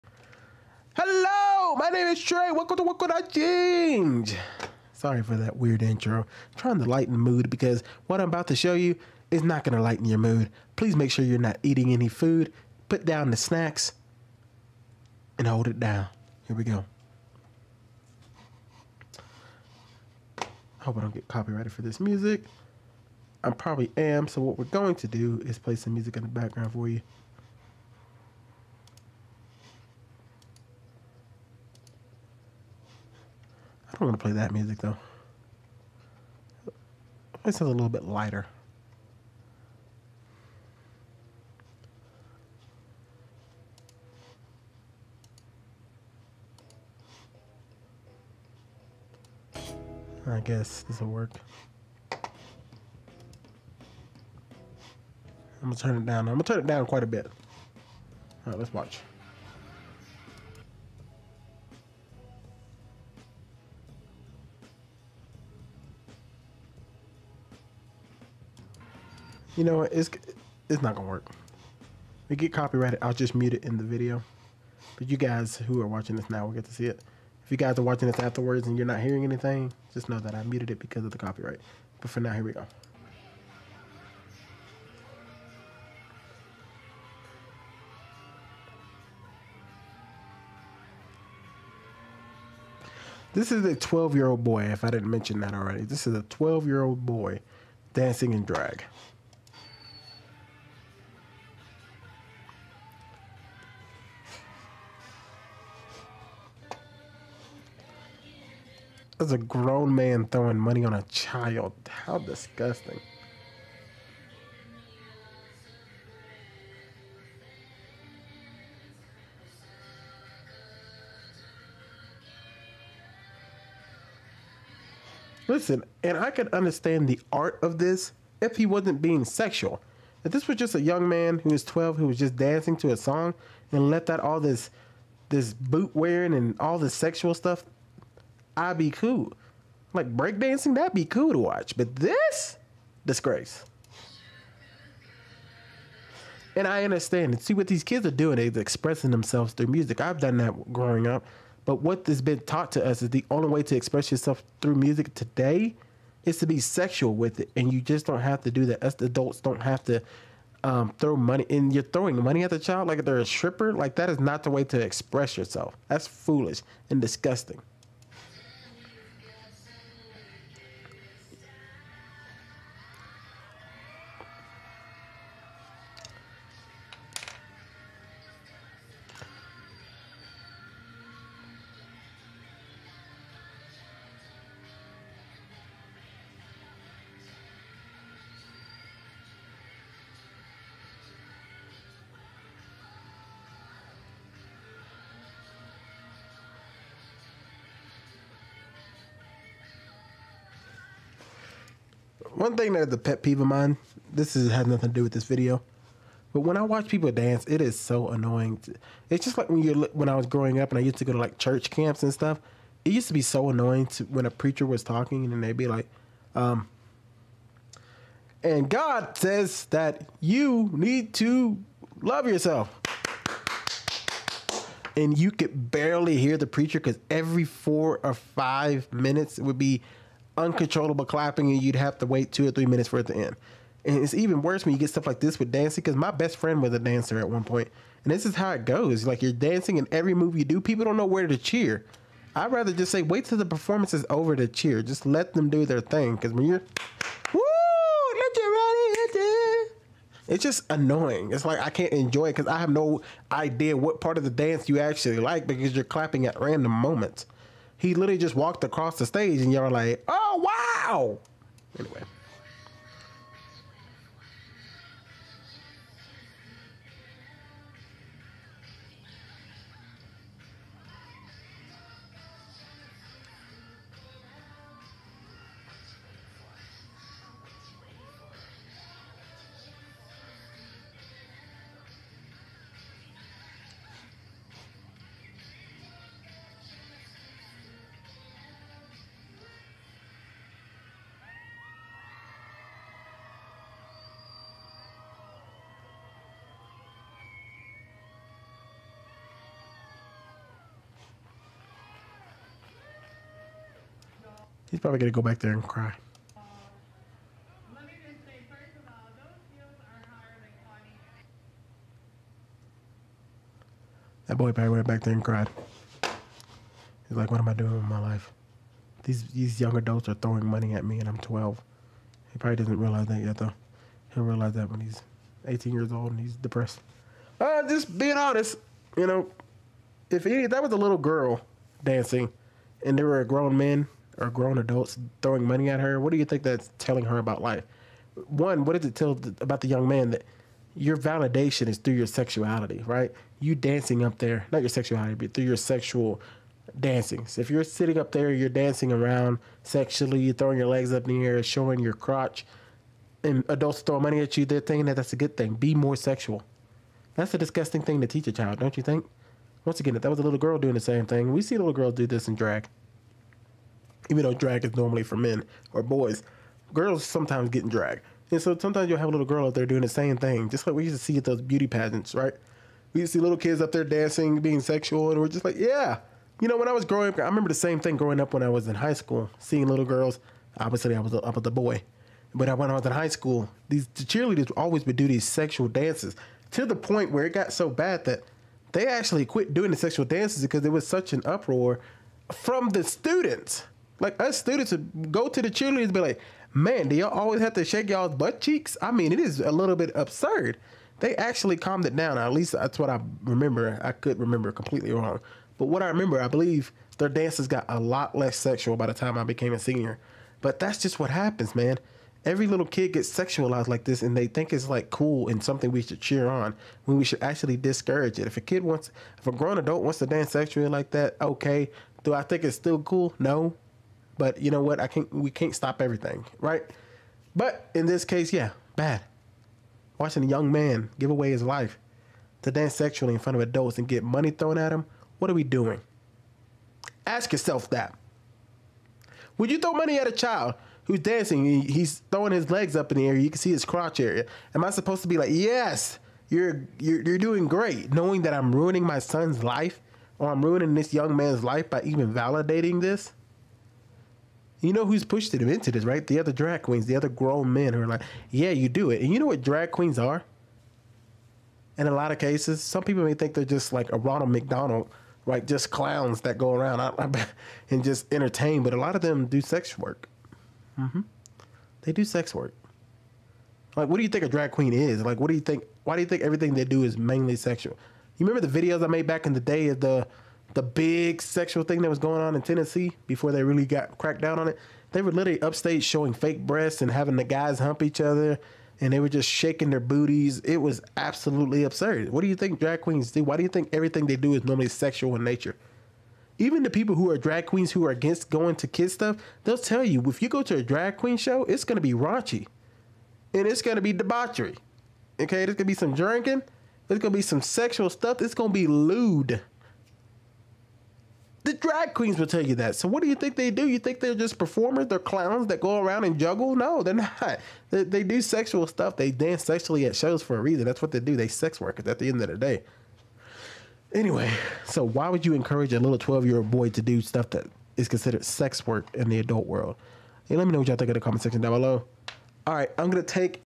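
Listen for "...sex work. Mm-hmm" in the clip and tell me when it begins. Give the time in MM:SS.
07:49.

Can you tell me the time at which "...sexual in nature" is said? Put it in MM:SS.
08:14.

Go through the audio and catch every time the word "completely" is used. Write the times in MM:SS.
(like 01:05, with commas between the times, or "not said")
06:44.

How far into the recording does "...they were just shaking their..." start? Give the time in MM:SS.
08:08.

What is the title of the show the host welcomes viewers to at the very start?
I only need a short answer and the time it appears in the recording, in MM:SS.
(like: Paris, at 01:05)
What Could I Change?, at 00:02.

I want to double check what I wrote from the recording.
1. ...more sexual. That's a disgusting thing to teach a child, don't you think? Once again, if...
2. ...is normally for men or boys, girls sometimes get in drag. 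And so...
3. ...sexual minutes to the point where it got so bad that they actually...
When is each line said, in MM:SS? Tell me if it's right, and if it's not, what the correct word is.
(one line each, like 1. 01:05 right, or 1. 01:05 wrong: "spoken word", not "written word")
1. 05:55 right
2. 06:04 right
3. 06:25 wrong: "dances", not "minutes".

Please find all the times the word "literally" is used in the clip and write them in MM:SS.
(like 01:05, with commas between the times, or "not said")
04:17, 08:05.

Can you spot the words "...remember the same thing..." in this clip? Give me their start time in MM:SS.
06:17.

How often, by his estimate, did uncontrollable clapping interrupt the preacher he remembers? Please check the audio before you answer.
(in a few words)
Every 4 or 5 minutes.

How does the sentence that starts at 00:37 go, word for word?
This sounds a little bit lighter.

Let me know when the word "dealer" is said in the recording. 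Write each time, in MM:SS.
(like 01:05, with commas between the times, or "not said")
not said.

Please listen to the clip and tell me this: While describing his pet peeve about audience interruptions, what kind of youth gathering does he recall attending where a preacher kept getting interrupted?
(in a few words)
Church camps.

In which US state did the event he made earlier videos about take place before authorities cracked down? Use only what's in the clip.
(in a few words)
Tennessee.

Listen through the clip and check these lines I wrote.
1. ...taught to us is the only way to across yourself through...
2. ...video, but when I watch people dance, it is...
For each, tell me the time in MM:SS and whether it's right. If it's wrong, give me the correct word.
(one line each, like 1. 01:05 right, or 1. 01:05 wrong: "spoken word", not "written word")
1. 02:32 wrong: "express", not "across"
2. 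03:25 right.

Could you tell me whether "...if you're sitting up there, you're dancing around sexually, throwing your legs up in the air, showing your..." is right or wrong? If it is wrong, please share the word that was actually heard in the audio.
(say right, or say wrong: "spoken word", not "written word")
right.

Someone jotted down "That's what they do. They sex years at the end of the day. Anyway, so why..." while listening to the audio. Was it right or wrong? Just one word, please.
wrong.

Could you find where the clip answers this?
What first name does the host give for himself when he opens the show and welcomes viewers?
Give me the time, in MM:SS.
00:02.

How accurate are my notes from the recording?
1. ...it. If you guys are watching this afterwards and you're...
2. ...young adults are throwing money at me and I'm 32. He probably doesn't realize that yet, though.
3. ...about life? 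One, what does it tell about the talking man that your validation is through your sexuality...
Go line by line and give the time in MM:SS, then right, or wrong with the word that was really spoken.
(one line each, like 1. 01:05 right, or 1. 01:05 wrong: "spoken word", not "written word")
1. 01:16 right
2. 05:19 wrong: "12", not "32"
3. 05:37 wrong: "young", not "talking".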